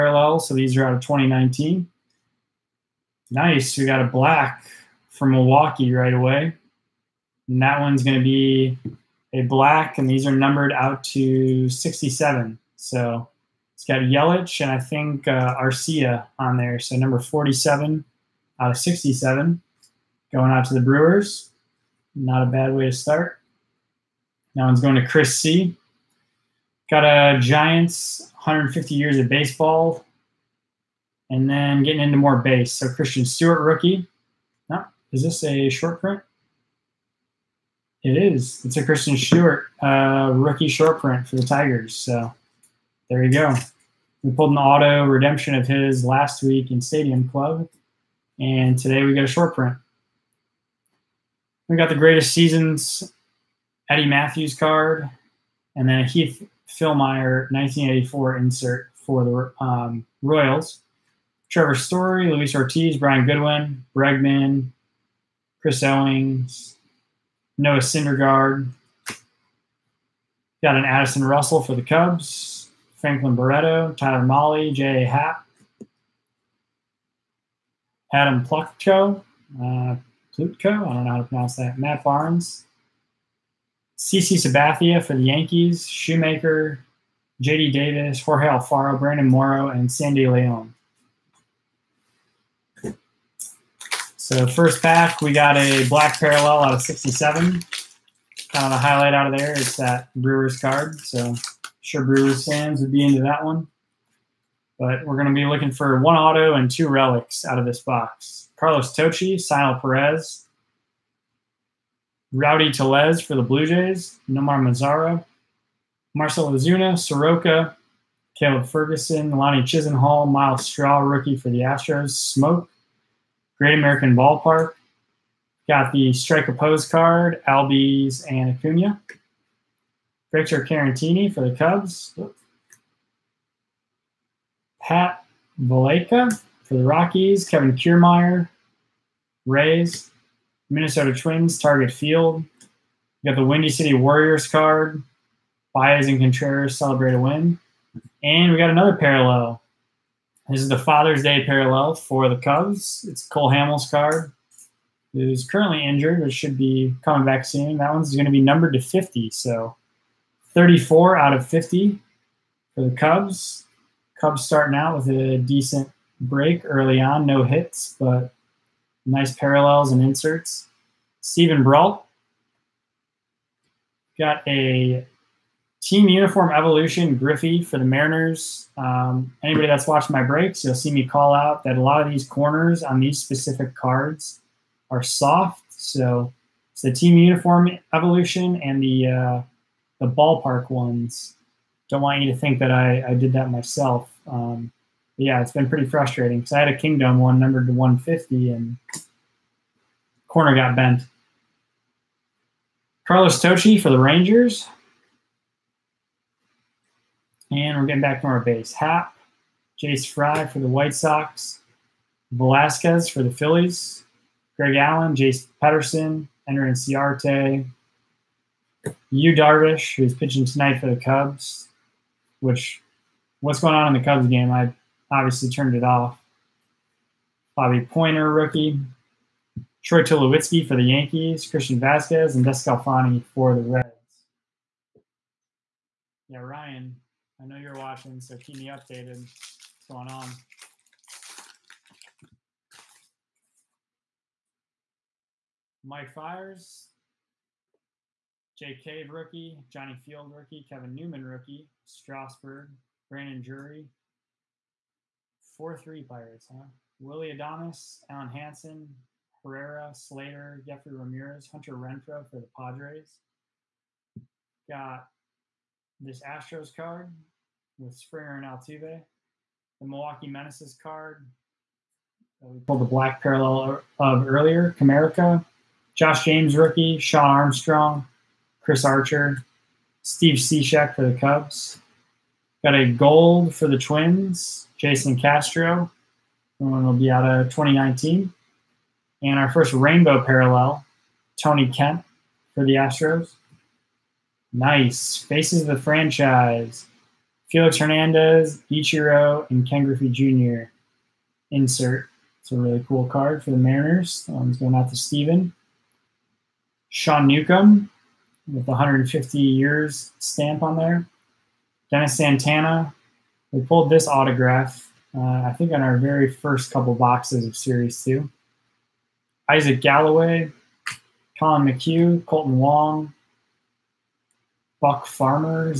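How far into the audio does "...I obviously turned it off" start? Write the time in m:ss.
3:44.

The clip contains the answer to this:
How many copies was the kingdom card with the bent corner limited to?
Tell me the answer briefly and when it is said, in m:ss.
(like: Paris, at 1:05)
150, at 3:17.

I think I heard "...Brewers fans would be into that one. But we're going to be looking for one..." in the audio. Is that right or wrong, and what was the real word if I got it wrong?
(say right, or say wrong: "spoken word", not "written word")
right.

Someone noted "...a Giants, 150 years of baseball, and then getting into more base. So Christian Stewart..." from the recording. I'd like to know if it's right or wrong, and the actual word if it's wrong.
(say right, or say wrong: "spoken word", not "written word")
right.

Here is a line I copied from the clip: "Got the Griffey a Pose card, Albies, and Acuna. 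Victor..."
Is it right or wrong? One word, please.
wrong.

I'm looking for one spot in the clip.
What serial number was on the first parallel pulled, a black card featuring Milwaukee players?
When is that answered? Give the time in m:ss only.
0:16.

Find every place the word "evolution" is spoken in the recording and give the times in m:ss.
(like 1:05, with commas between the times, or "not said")
2:56, 3:07.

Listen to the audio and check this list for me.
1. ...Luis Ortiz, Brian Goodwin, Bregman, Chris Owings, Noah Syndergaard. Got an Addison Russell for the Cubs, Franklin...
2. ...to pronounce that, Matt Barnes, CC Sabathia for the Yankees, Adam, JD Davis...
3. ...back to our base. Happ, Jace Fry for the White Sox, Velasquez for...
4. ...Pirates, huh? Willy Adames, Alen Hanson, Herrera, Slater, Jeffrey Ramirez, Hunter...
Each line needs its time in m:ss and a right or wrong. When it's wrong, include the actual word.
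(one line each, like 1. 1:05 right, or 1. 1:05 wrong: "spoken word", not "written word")
1. 1:02 right
2. 1:21 wrong: "Shoemaker", not "Adam"
3. 3:28 right
4. 4:16 right.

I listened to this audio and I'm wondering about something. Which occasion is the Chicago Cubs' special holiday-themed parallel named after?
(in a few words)
Father's Day.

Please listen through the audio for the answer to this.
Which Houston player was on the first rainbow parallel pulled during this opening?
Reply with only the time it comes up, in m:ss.
4:51.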